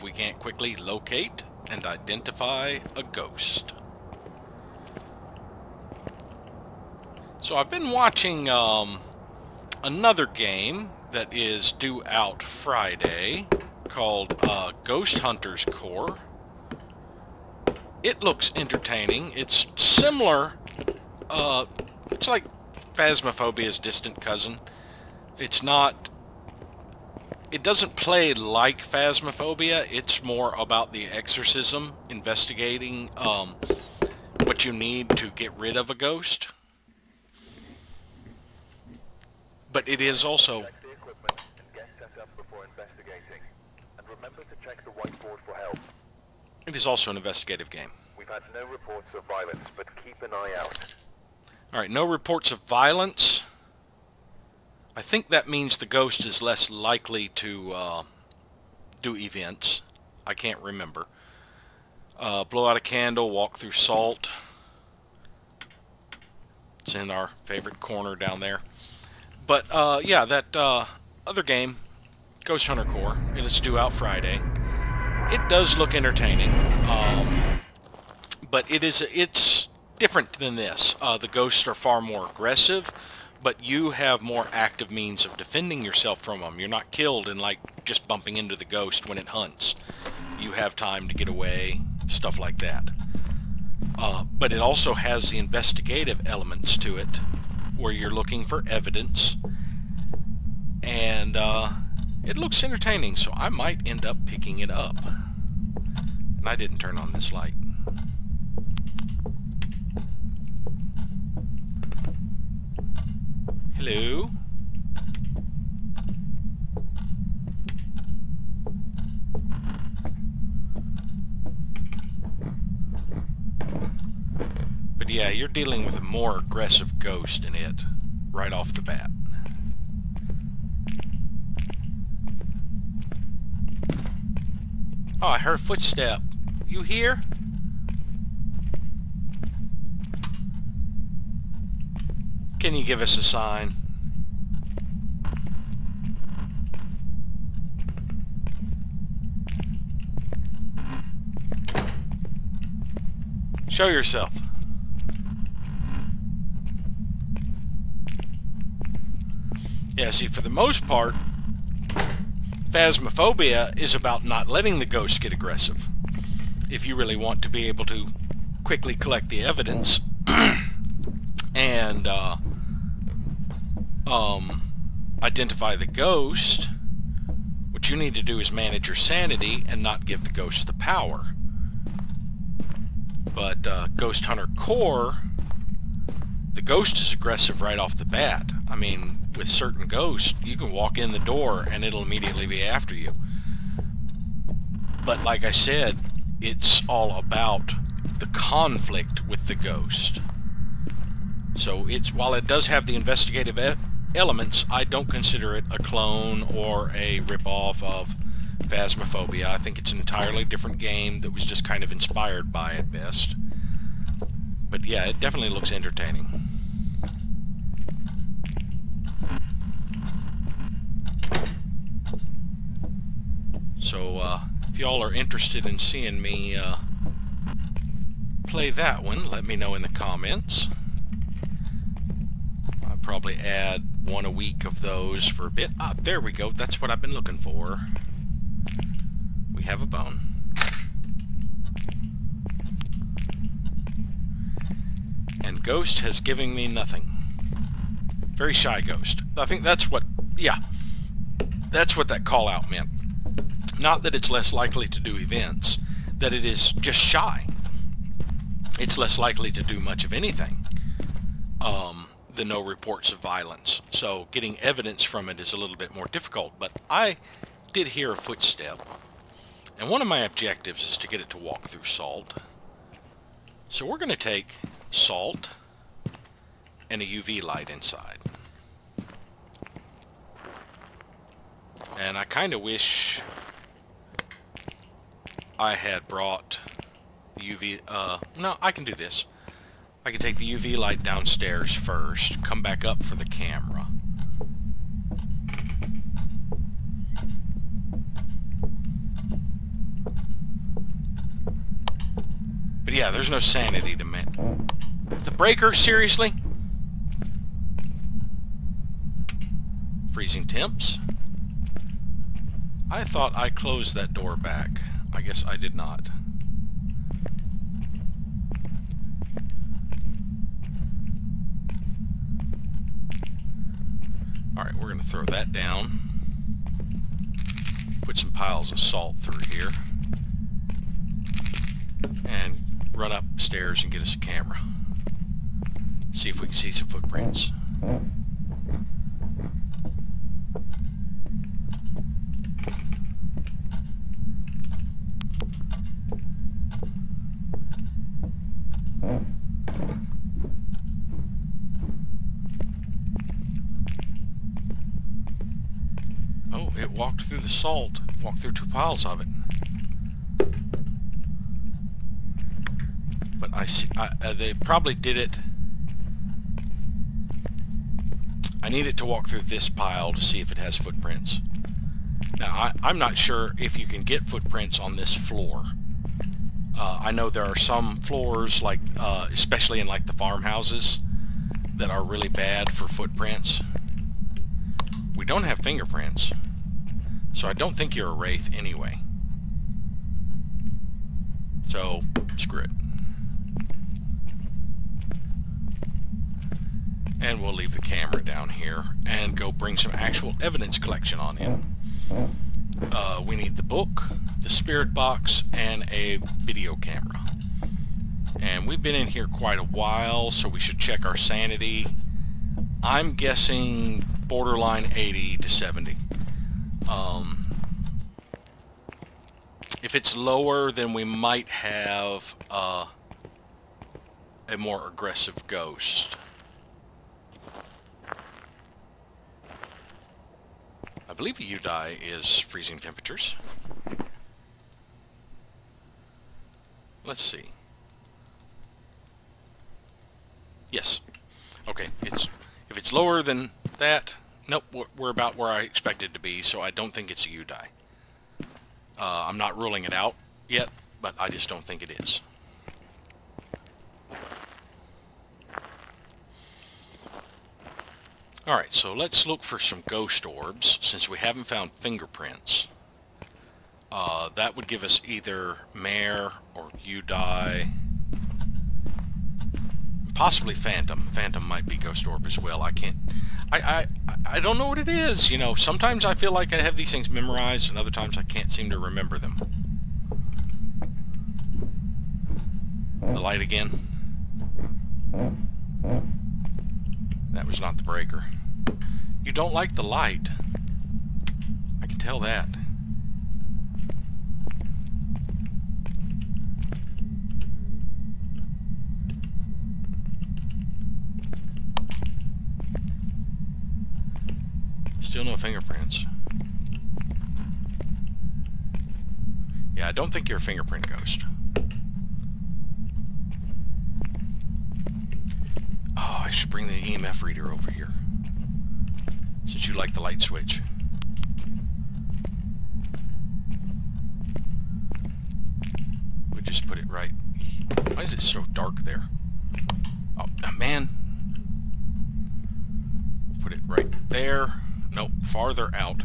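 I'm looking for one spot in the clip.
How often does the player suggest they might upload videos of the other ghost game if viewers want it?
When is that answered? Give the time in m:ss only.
3:54.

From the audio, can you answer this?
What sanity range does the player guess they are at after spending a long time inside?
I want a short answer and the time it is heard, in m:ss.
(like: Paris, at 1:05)
80 to 70, at 6:54.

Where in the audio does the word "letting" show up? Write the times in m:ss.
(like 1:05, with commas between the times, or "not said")
2:44.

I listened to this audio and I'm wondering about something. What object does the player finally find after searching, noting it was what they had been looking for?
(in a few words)
A bone.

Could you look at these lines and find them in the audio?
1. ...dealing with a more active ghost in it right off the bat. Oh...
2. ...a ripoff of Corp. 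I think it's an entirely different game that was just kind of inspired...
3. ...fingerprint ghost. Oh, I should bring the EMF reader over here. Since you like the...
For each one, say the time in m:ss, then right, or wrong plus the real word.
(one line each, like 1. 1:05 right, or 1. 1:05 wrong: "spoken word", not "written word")
1. 2:05 wrong: "aggressive", not "active"
2. 3:26 wrong: "Phasmophobia", not "Corp"
3. 8:30 right.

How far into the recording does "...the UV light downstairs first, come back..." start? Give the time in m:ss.
4:50.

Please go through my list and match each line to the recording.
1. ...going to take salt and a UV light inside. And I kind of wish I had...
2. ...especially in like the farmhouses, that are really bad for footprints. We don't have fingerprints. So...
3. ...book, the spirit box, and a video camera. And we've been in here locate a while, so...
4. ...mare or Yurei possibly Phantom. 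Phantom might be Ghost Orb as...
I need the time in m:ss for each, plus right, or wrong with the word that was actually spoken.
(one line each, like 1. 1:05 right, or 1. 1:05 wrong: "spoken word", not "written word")
1. 4:33 right
2. 6:19 right
3. 6:43 wrong: "quite", not "locate"
4. 7:45 right.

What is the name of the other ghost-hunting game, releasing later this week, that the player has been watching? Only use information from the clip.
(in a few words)
Ghost Hunters Corp.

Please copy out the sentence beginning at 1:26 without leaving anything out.
You're not killed and like just bumping into the ghost when it hunts.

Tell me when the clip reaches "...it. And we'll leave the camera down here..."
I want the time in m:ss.
6:32.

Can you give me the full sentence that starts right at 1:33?
Uh, but it also has the investigative elements to it, where you're looking for evidence and.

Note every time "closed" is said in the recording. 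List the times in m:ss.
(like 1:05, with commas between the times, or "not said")
5:13.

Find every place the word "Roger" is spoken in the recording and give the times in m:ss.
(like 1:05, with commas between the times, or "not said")
not said.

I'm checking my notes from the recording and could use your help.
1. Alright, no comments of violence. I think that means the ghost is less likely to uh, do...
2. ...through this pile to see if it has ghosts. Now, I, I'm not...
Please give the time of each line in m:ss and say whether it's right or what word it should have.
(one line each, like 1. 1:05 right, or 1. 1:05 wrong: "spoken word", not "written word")
1. 0:51 wrong: "reports", not "comments"
2. 6:09 wrong: "footprints", not "ghosts".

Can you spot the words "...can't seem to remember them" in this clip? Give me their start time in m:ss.
7:58.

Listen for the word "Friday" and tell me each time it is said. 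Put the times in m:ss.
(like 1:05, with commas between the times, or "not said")
0:12, 1:13.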